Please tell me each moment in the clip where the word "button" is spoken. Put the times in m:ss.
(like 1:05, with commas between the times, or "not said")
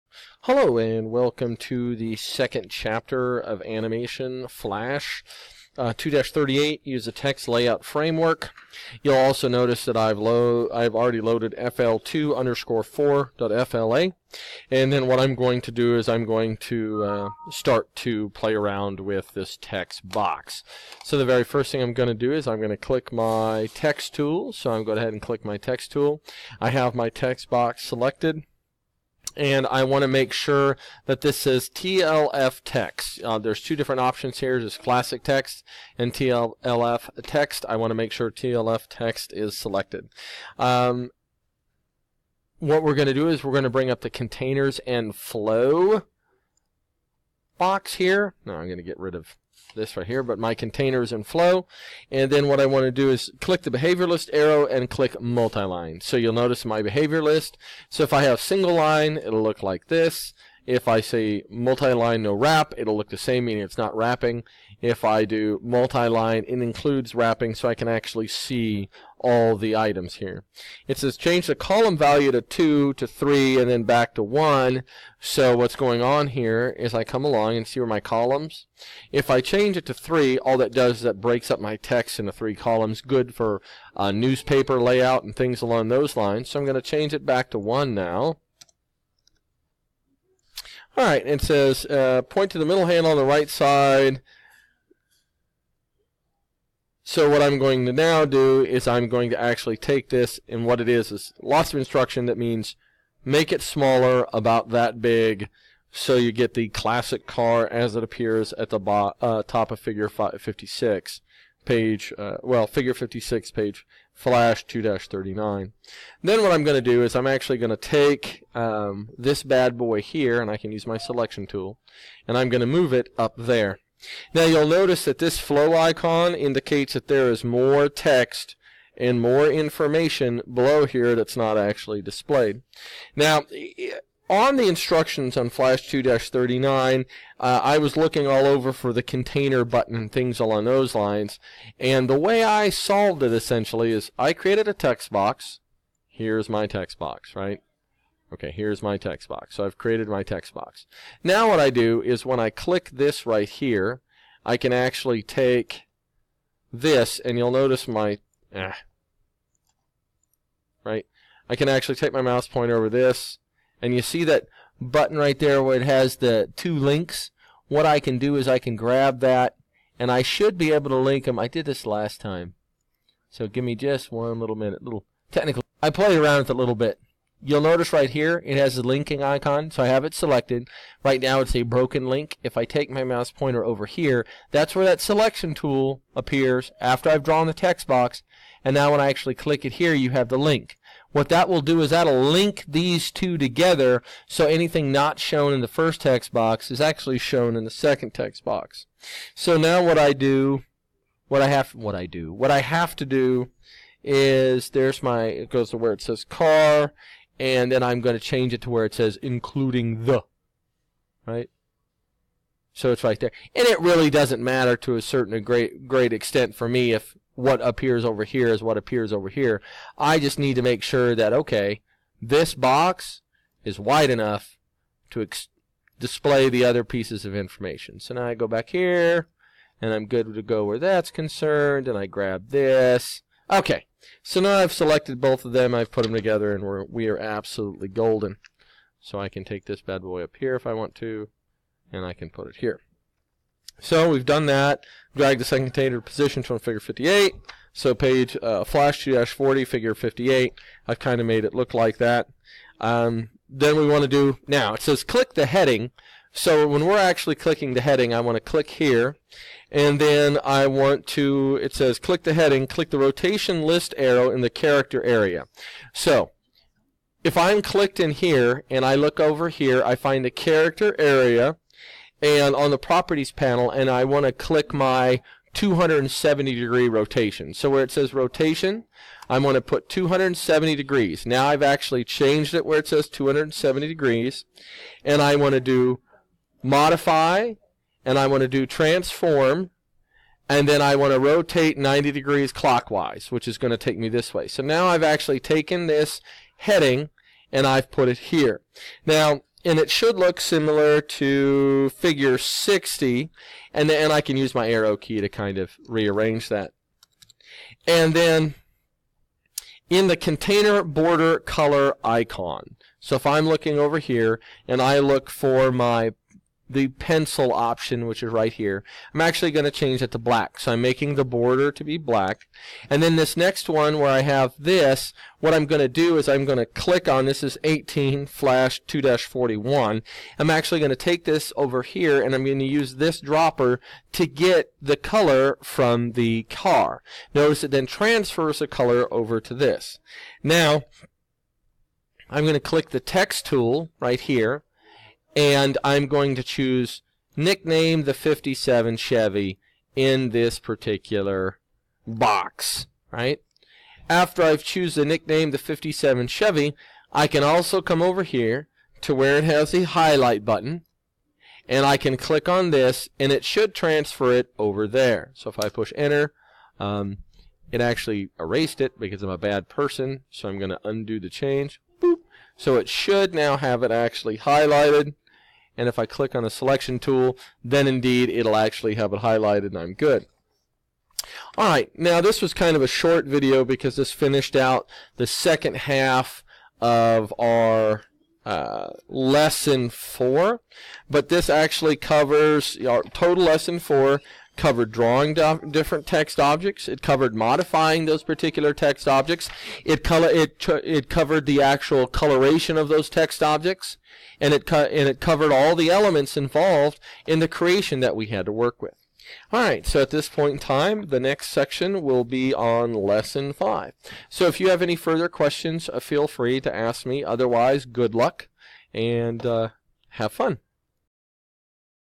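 2:19, 2:44, 6:00.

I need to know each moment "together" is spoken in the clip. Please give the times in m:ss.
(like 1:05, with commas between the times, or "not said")
3:13, 3:56.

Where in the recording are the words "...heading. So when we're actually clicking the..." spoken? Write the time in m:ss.
4:15.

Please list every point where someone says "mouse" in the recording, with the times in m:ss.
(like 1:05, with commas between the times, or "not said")
2:42, 3:03.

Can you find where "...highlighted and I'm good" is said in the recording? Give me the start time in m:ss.
6:19.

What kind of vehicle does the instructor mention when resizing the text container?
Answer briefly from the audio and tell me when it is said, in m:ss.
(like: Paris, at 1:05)
classic car, at 1:46.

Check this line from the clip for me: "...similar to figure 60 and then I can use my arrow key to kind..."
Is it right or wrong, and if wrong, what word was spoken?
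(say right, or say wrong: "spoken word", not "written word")
right.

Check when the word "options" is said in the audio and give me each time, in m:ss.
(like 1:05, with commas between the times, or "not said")
0:34, 5:17.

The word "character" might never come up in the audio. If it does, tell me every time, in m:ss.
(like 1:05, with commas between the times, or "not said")
4:24, 4:30.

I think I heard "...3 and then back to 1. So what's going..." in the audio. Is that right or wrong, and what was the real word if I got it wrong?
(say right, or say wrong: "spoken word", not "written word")
right.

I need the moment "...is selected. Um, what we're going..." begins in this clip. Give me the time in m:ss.
0:39.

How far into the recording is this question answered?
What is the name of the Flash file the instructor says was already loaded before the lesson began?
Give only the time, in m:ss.
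0:11.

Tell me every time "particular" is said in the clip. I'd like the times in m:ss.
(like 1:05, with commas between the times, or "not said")
5:50, 6:38.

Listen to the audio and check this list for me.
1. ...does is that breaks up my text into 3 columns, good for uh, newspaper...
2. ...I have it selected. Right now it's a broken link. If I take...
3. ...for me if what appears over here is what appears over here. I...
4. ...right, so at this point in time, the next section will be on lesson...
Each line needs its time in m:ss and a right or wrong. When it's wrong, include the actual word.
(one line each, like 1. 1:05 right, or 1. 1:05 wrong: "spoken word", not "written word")
1. 1:20 right
2. 2:59 right
3. 3:36 right
4. 6:49 right.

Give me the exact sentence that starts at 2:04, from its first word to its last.
Now you'll notice that this flow icon indicates that there is more text and more information below here that's not actually displayed.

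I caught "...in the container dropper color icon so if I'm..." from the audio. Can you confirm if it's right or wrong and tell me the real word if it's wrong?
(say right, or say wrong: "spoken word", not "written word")
wrong: "border", not "dropper".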